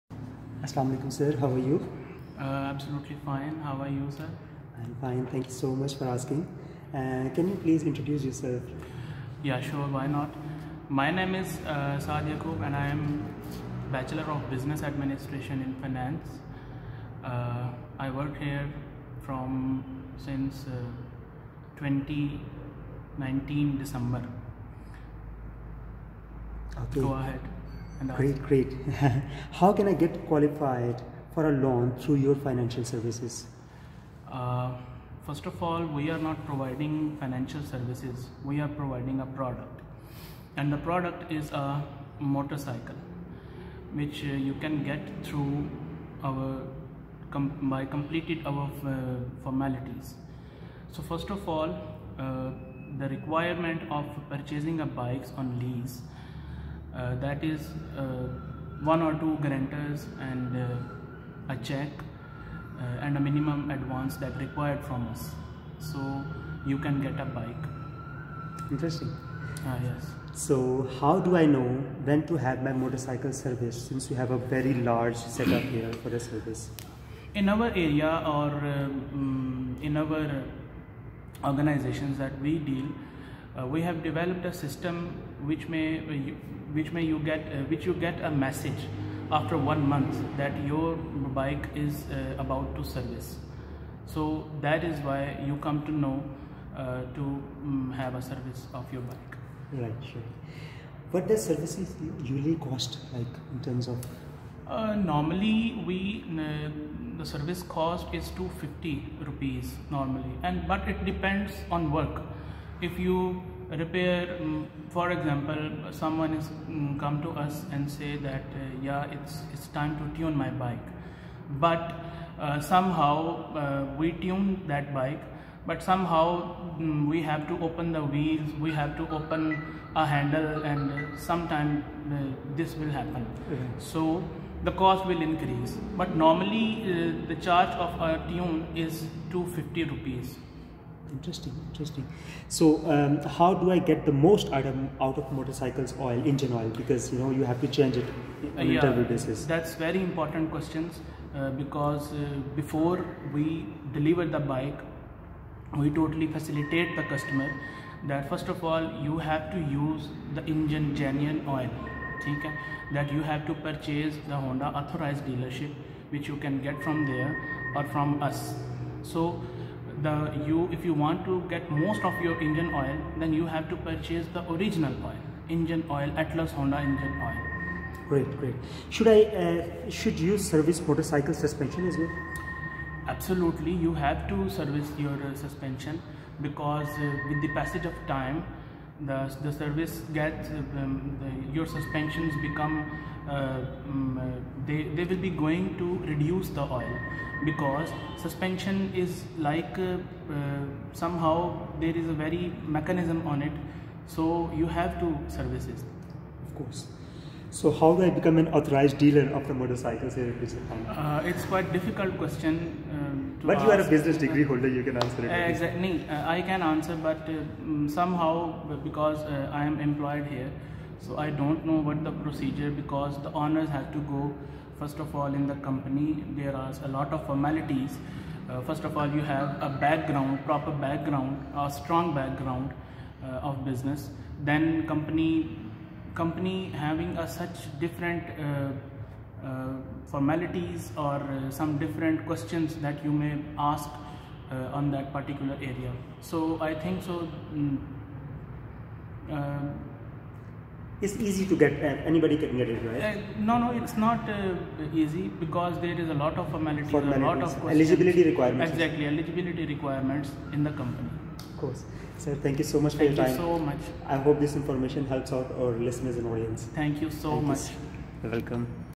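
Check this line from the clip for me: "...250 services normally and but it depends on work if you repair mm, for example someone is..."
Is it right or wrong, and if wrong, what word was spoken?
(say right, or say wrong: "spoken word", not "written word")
wrong: "rupees", not "services".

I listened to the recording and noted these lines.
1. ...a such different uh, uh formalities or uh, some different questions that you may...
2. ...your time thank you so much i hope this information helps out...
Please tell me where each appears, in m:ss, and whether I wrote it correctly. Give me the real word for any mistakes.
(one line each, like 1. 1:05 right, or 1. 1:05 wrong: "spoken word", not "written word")
1. 3:57 right
2. 4:23 right.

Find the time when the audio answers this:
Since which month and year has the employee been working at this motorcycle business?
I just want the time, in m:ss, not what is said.
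0:21.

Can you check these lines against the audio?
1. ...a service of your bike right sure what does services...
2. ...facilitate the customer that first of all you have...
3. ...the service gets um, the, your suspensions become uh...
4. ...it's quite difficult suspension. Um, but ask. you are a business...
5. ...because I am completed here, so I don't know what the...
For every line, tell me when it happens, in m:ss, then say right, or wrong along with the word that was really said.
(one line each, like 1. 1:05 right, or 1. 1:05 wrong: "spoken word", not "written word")
1. 1:38 right
2. 2:36 right
3. 3:09 right
4. 3:31 wrong: "question", not "suspension"
5. 3:38 wrong: "employed", not "completed".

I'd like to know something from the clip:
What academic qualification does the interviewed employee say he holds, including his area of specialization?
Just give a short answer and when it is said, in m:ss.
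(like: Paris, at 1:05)
Bachelor of Business Administration in Finance, at 0:13.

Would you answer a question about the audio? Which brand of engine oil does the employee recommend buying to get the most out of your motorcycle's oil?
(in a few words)
Atlas Honda.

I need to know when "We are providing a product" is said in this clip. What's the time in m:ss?
0:38.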